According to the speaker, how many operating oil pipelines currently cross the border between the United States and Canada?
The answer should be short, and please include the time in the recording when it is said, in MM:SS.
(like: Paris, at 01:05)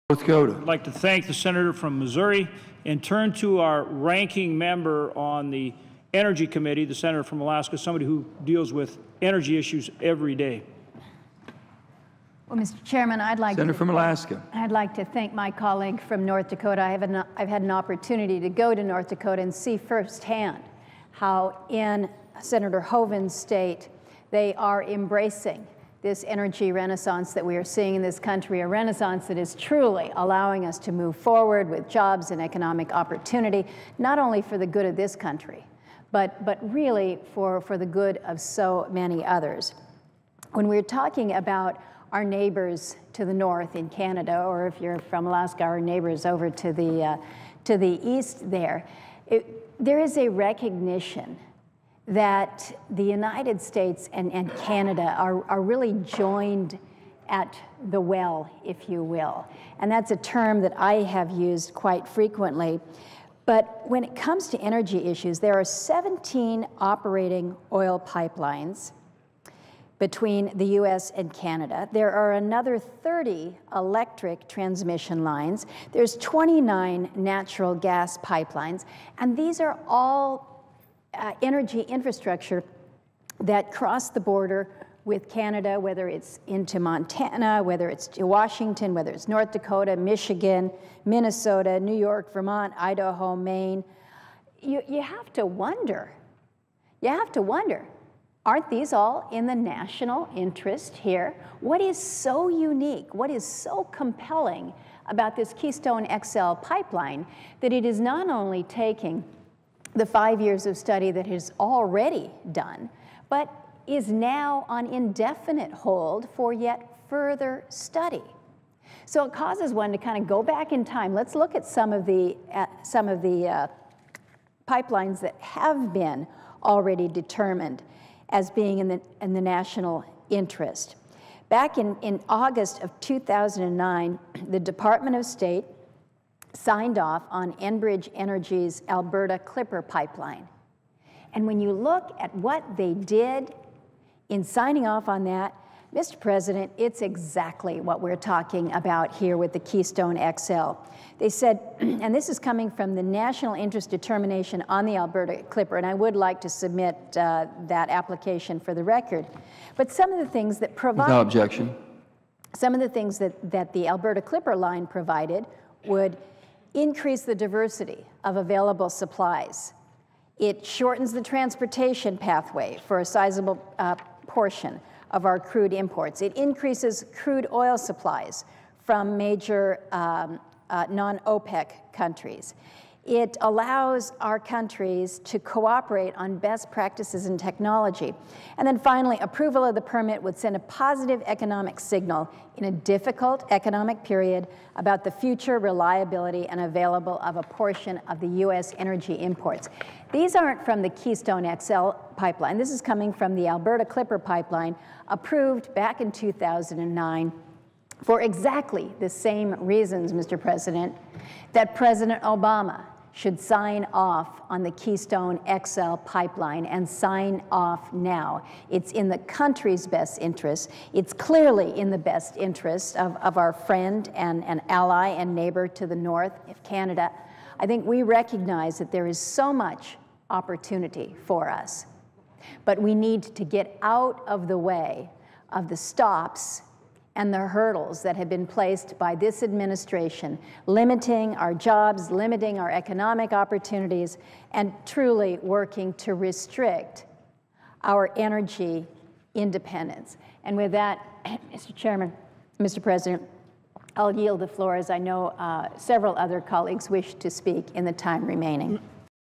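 17, at 01:05.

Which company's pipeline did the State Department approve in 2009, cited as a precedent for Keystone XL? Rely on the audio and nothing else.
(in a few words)
Enbridge Energy.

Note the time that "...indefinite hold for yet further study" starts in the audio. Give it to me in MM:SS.
01:54.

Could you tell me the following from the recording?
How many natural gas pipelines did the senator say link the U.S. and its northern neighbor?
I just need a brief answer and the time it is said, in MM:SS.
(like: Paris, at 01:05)
29, at 01:16.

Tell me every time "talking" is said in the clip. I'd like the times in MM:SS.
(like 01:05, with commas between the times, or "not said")
00:40, 02:28.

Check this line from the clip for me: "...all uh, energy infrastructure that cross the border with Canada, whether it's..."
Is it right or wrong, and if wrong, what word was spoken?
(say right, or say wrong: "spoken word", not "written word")
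right.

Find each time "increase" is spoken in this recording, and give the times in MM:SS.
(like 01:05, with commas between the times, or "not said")
02:46, 02:56.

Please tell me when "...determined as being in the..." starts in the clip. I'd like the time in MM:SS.
02:07.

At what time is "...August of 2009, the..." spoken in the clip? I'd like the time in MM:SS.
02:12.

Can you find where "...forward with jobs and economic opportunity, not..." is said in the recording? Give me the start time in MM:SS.
00:31.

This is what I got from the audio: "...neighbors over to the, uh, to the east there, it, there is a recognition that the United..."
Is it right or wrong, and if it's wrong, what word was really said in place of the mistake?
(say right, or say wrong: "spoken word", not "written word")
right.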